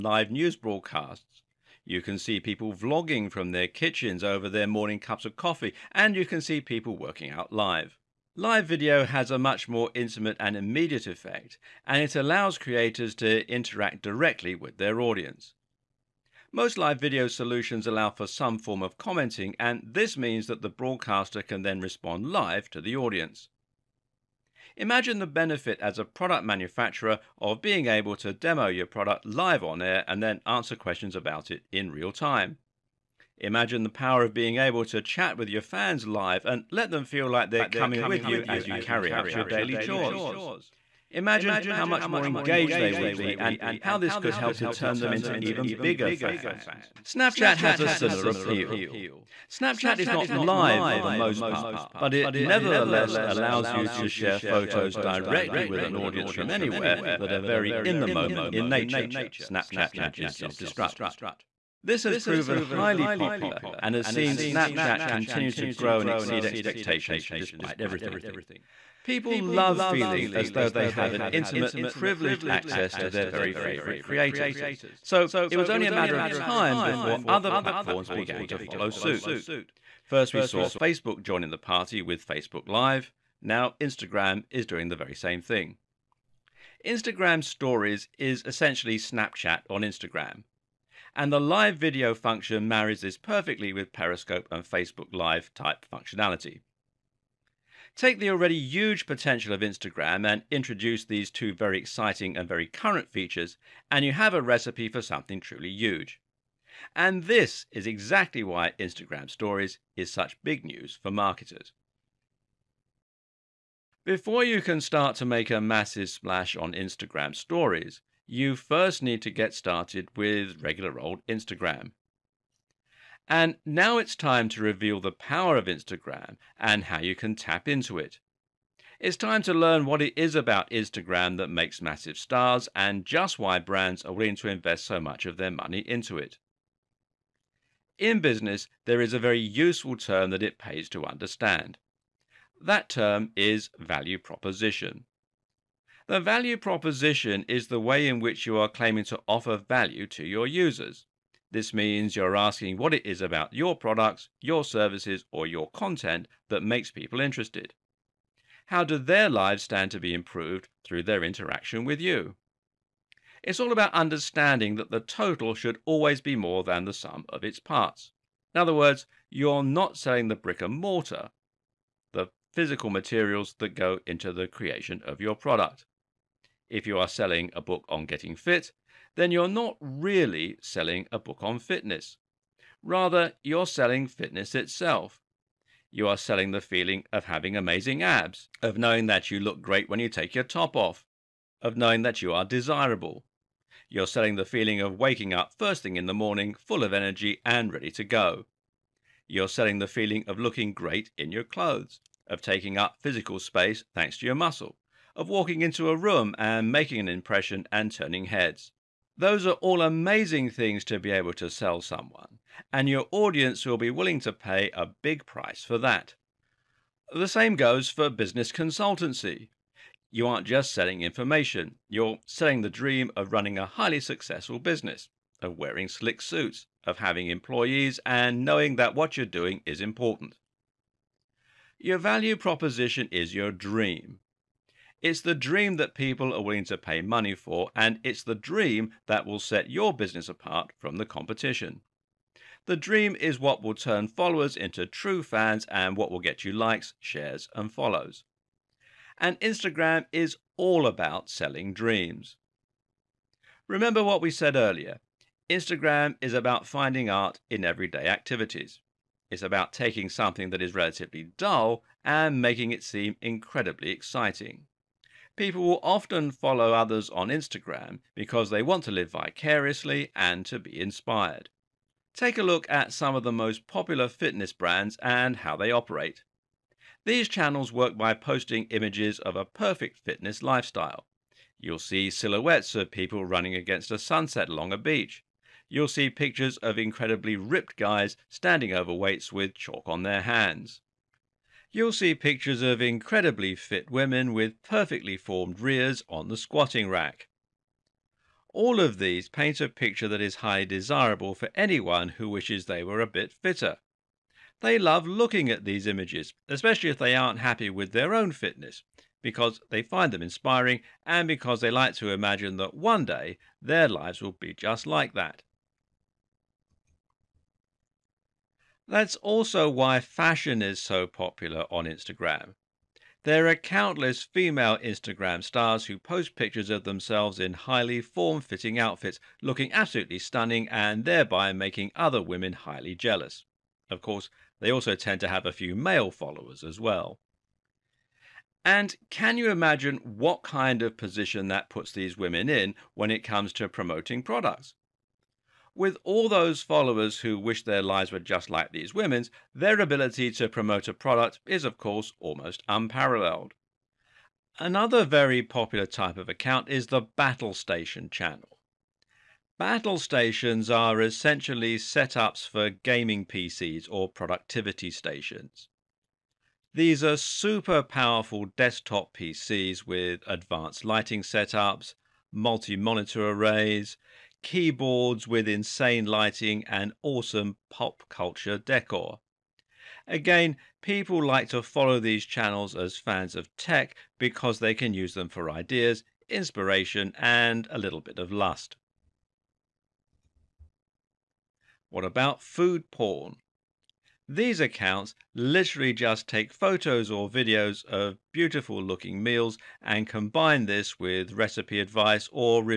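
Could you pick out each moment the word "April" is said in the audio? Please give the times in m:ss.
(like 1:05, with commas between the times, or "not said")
not said.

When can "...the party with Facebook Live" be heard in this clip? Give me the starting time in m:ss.
1:21.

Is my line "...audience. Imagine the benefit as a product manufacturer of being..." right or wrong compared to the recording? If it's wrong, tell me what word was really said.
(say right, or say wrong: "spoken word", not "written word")
right.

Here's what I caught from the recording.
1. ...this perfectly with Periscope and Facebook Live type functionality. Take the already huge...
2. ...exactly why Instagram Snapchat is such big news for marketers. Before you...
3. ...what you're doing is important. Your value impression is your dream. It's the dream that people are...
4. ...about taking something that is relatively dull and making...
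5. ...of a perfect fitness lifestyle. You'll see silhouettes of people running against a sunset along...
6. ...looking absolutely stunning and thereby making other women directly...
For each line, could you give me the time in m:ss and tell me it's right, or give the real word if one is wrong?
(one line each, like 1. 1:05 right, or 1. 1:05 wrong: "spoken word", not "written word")
1. 1:33 right
2. 1:47 wrong: "Stories", not "Snapchat"
3. 3:48 wrong: "proposition", not "impression"
4. 4:19 right
5. 4:39 right
6. 5:29 wrong: "highly", not "directly".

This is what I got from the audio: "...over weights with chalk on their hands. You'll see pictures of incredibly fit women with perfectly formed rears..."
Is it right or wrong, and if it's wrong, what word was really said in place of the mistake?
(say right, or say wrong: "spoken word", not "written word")
right.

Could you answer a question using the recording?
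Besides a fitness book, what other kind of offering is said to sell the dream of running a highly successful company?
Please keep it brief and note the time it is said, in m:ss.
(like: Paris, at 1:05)
business consultancy, at 3:38.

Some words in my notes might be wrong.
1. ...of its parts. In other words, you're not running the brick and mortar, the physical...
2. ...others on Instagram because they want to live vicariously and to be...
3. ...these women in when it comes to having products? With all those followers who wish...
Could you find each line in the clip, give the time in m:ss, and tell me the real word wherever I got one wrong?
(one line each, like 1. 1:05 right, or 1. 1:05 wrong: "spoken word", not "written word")
1. 2:47 wrong: "selling", not "running"
2. 4:26 right
3. 5:41 wrong: "promoting", not "having".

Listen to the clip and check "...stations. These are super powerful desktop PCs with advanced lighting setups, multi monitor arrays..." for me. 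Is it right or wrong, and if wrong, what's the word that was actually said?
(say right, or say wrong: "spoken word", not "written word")
right.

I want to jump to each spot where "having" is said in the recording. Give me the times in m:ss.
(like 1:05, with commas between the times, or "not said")
3:07, 3:46.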